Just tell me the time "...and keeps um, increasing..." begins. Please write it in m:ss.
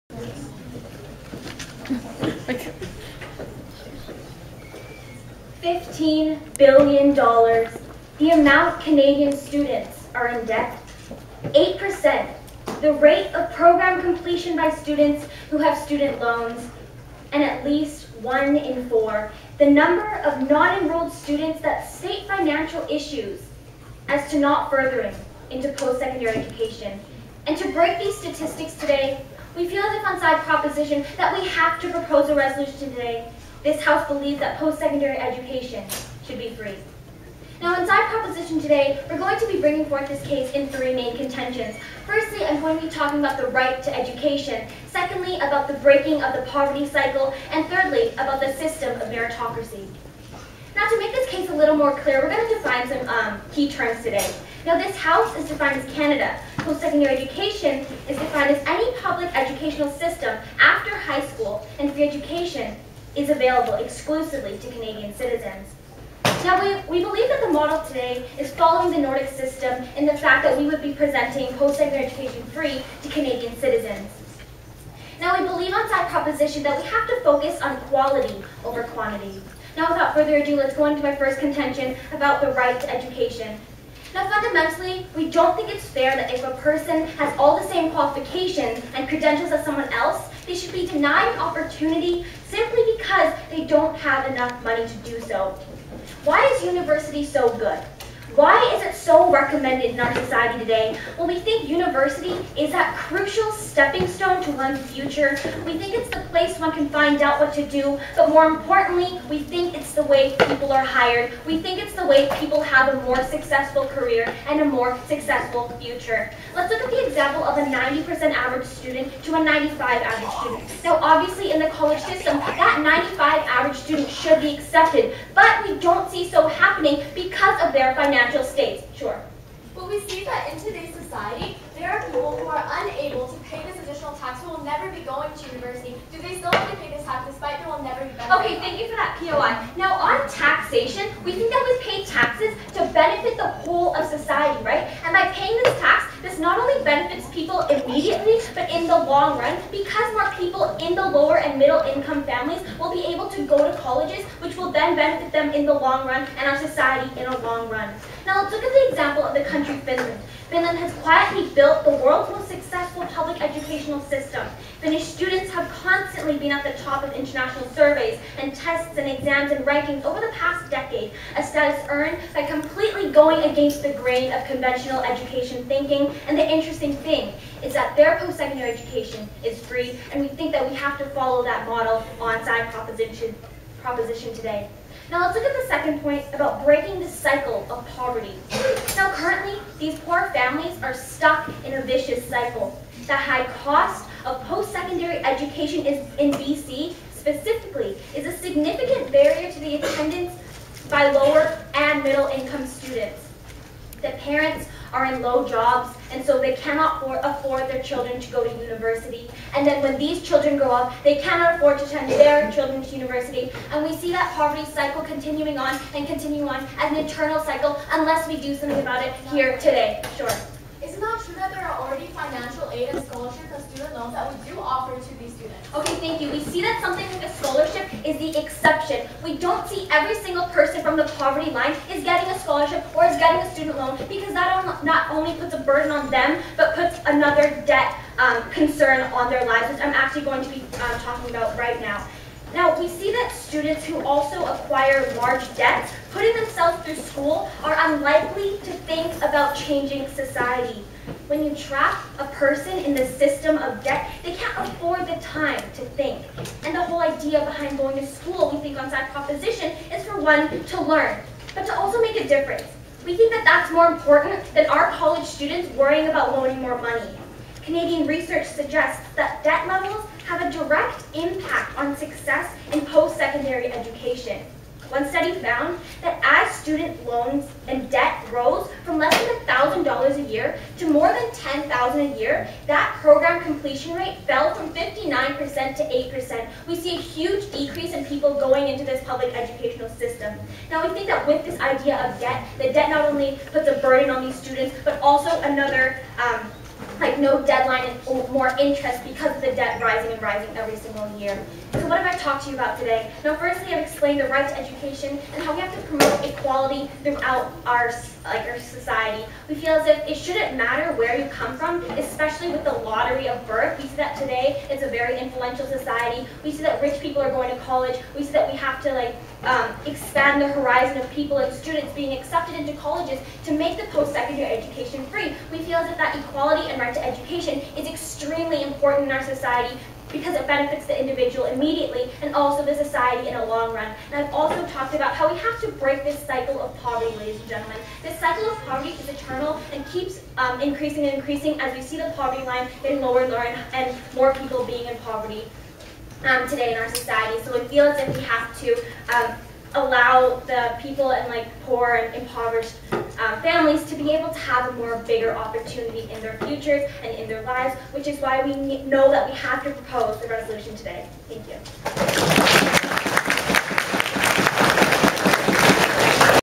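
5:39.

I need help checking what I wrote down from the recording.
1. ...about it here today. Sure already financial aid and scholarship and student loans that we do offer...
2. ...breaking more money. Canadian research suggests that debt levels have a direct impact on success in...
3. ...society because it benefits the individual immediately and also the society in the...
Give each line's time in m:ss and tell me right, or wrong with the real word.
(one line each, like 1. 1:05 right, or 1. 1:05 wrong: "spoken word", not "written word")
1. 3:38 right
2. 4:26 wrong: "loaning", not "breaking"
3. 5:29 right.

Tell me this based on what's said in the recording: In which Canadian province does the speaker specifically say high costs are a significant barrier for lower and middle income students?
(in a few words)
BC.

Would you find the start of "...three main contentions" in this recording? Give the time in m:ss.
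0:40.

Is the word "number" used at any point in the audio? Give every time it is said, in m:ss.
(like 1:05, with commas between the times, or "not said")
0:19.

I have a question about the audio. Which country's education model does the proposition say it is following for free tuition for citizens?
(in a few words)
Nordic system.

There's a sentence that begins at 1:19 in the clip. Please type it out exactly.
Now, without further ado, let's go into my first contention about the right to education.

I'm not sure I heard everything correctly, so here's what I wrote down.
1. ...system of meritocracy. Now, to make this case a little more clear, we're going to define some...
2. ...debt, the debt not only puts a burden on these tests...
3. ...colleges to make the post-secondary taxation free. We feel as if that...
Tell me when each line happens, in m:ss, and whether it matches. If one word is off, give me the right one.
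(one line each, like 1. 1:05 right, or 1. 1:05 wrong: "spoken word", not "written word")
1. 0:48 right
2. 4:52 wrong: "students", not "tests"
3. 5:22 wrong: "education", not "taxation".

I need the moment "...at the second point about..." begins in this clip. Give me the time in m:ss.
3:05.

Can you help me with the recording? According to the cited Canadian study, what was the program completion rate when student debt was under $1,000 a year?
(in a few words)
59%.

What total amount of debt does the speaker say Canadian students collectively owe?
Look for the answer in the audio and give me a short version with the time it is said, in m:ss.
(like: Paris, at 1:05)
$15 billion, at 0:05.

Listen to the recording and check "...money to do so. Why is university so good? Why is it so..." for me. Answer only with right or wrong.
right.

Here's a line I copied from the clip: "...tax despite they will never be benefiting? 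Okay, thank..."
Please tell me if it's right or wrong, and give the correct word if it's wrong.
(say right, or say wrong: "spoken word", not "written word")
right.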